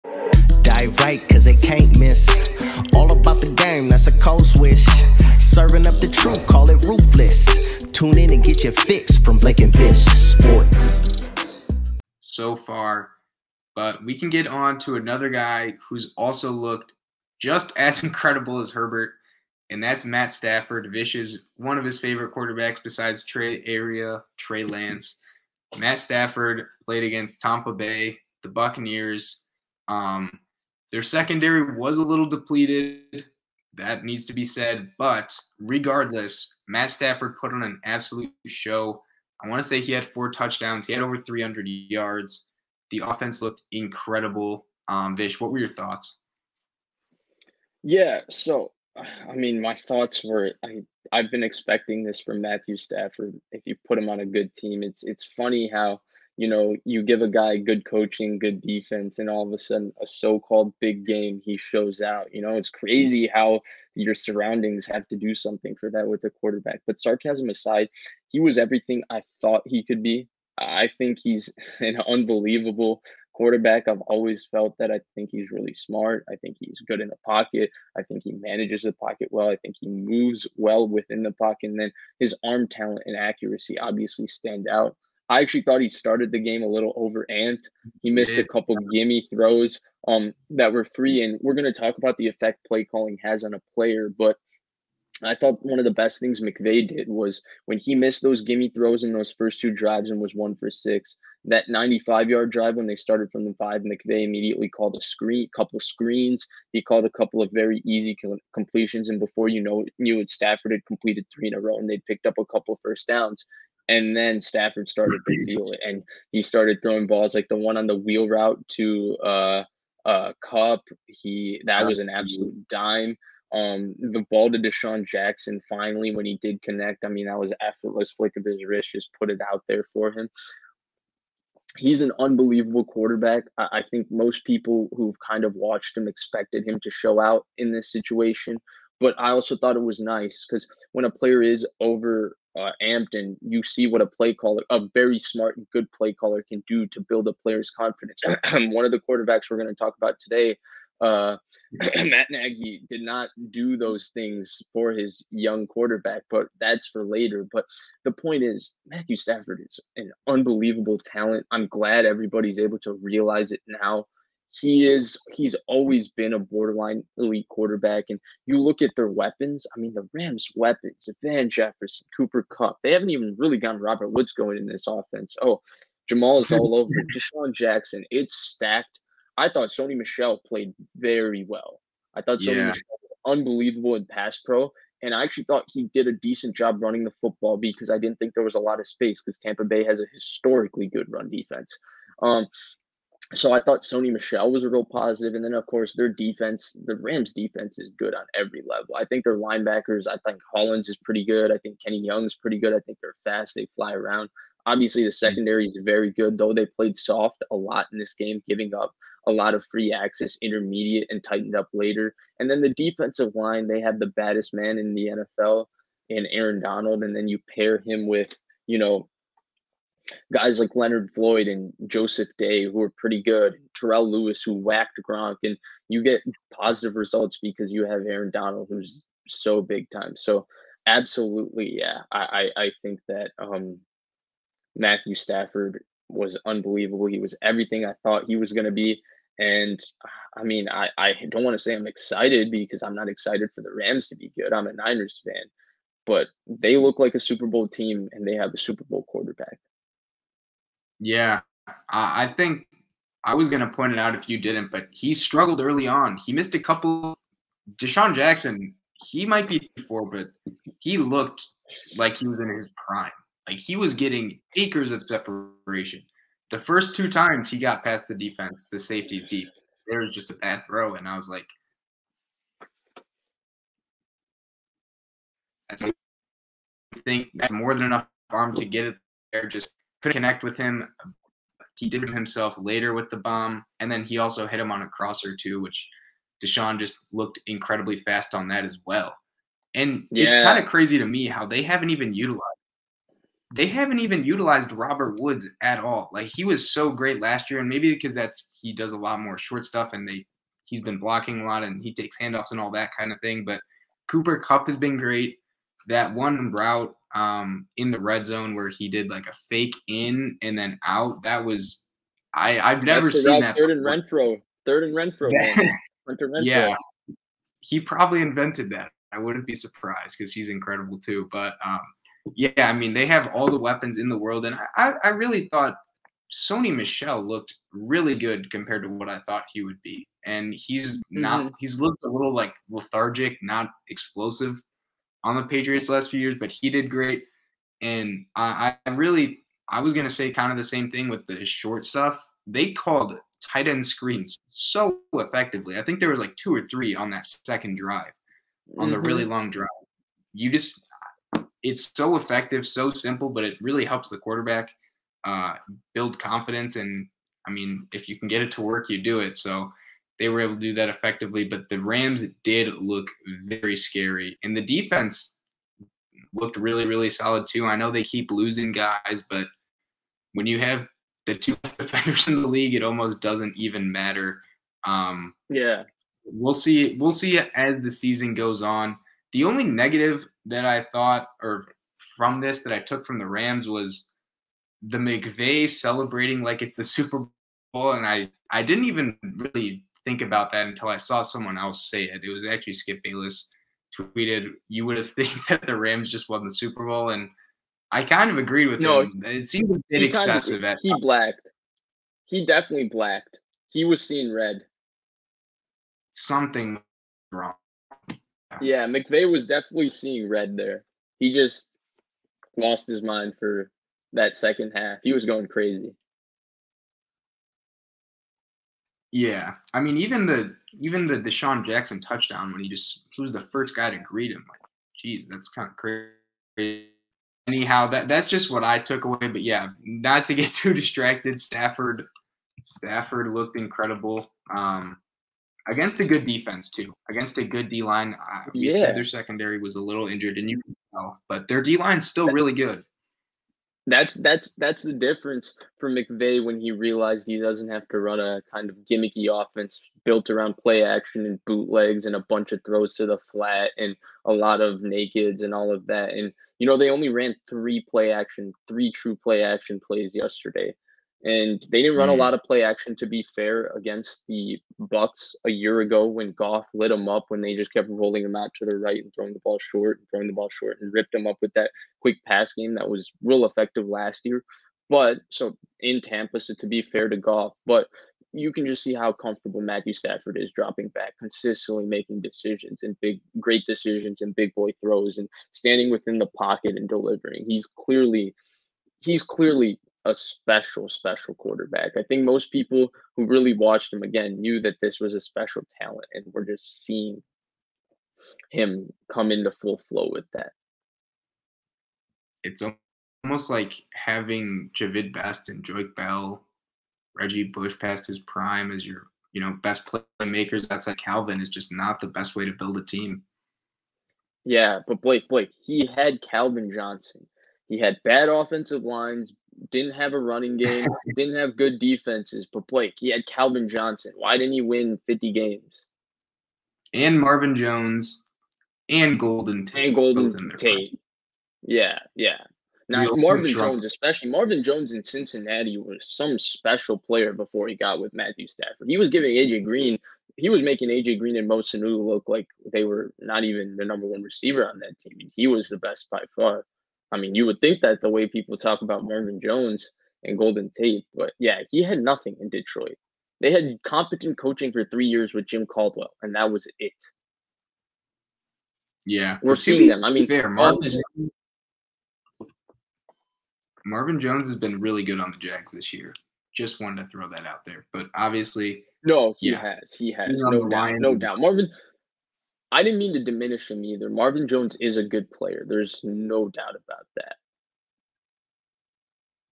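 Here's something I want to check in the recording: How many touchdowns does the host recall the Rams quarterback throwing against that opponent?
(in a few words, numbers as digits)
4.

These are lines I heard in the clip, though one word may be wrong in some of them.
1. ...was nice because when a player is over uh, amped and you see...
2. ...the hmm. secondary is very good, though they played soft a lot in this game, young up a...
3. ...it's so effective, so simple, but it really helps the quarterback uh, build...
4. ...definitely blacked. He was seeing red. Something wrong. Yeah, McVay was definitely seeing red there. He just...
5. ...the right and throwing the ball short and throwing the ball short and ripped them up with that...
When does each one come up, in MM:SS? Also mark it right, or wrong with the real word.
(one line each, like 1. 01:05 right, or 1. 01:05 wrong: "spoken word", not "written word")
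1. 02:19 right
2. 03:25 wrong: "giving", not "young"
3. 05:51 right
4. 06:42 right
5. 07:48 right.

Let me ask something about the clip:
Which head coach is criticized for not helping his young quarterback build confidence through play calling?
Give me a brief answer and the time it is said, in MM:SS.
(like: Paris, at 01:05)
Matt Nagy, at 02:32.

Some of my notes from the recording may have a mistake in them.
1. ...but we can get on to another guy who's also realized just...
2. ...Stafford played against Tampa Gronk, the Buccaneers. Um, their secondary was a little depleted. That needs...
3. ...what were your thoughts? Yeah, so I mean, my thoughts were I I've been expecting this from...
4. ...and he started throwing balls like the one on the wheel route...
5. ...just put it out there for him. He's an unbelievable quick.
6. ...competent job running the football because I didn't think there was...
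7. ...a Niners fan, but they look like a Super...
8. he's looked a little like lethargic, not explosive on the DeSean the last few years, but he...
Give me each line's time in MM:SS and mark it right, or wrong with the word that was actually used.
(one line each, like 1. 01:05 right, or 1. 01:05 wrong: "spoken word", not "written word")
1. 00:13 wrong: "looked", not "realized"
2. 00:25 wrong: "Bay", not "Gronk"
3. 00:45 right
4. 01:55 right
5. 02:08 wrong: "quarterback", not "quick"
6. 03:06 wrong: "decent", not "competent"
7. 04:04 right
8. 05:31 wrong: "Patriots", not "DeSean".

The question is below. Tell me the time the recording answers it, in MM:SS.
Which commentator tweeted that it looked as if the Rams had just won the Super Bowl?
06:32.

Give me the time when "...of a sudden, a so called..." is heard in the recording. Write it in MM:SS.
00:59.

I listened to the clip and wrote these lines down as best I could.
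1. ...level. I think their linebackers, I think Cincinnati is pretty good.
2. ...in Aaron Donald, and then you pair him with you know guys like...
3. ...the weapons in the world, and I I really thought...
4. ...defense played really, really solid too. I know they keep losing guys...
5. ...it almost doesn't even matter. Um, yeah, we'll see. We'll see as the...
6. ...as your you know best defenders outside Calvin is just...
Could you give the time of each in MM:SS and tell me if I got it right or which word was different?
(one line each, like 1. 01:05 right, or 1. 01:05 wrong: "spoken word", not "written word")
1. 03:18 wrong: "Hollins", not "Cincinnati"
2. 03:36 right
3. 05:23 right
4. 06:04 wrong: "looked", not "played"
5. 06:12 right
6. 08:28 wrong: "playmakers", not "defenders".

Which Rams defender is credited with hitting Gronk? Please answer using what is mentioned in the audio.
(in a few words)
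Terrell Lewis.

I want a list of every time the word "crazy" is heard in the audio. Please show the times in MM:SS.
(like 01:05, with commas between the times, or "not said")
01:02, 04:50, 06:55, 07:05.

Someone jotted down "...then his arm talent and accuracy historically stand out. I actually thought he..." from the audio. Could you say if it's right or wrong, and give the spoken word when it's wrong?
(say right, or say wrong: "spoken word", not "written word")
wrong: "obviously", not "historically".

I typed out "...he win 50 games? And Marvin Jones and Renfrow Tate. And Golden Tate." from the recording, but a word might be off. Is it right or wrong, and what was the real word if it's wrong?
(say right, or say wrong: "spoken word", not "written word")
wrong: "Golden", not "Renfrow".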